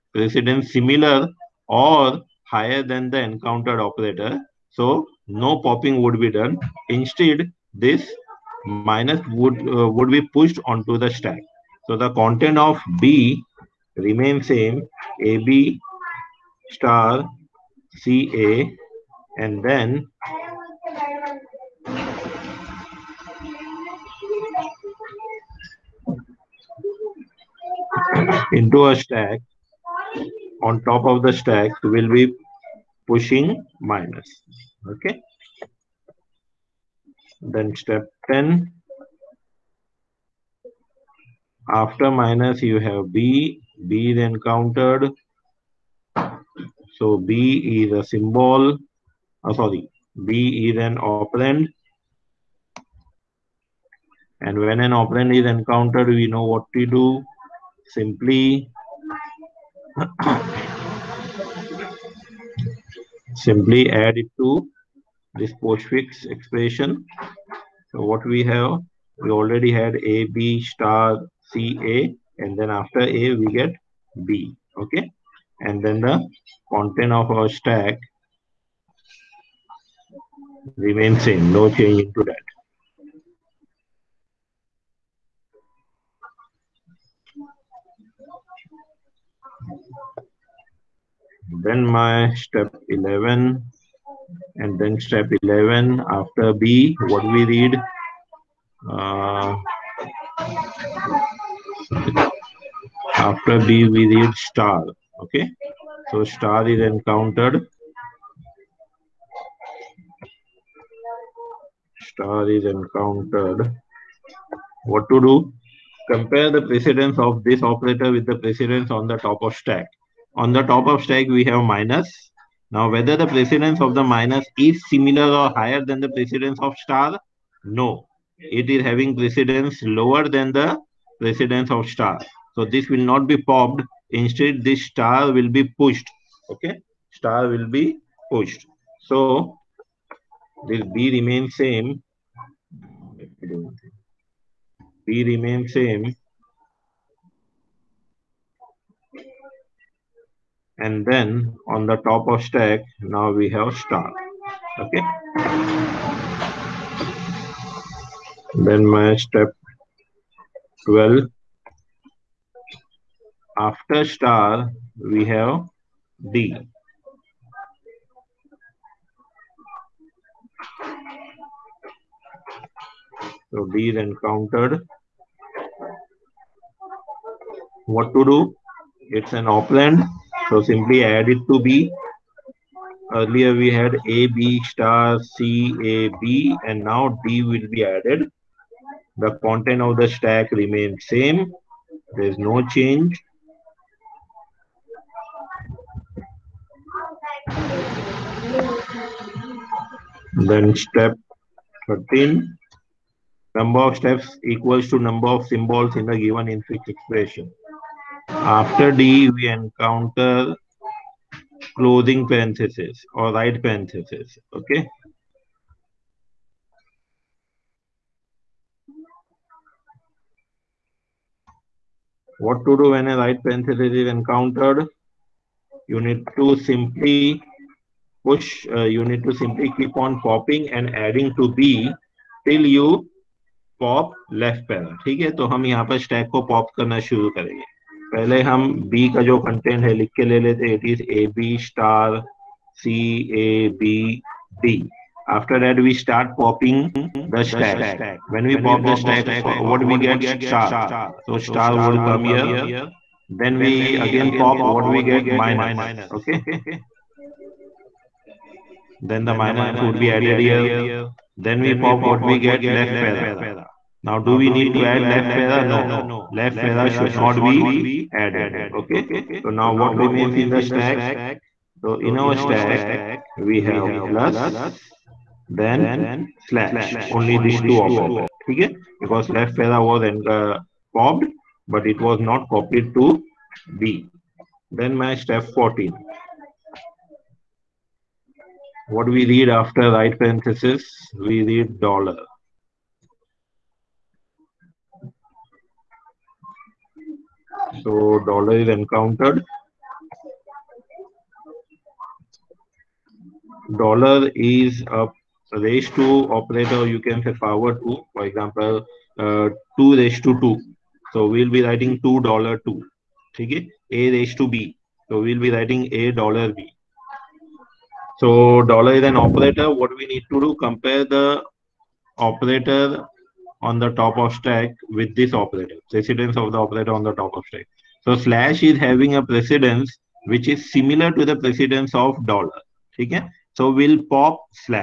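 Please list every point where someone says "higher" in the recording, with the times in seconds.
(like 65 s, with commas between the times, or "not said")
2 s, 125 s.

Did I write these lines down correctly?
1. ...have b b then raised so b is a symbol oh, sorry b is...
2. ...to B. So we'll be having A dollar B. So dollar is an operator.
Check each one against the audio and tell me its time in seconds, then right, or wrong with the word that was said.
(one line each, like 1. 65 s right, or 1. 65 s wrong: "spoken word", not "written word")
1. 42 s wrong: "countered", not "raised"
2. 314 s wrong: "writing", not "having".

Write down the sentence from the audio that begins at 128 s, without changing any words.
It is having precedence lower than the precedence of star.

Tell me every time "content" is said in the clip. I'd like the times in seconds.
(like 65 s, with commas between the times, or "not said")
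12 s, 76 s, 189 s.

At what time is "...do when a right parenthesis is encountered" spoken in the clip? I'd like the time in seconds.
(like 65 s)
222 s.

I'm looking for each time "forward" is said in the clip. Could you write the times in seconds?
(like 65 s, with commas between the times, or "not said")
307 s.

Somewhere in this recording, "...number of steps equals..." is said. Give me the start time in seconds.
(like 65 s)
203 s.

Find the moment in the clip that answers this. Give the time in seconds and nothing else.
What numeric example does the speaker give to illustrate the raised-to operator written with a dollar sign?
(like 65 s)
309 s.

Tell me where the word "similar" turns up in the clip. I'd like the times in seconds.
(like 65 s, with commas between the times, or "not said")
0 s, 124 s, 330 s.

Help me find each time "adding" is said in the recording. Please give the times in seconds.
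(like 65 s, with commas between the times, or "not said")
230 s.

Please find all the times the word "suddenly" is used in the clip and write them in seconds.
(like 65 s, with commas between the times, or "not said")
not said.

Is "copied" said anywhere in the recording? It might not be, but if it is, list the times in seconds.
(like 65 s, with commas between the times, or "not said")
282 s.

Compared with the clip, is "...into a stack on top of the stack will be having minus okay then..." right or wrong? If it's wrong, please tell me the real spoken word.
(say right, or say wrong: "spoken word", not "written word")
wrong: "pushing", not "having".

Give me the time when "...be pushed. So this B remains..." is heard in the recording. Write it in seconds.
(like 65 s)
137 s.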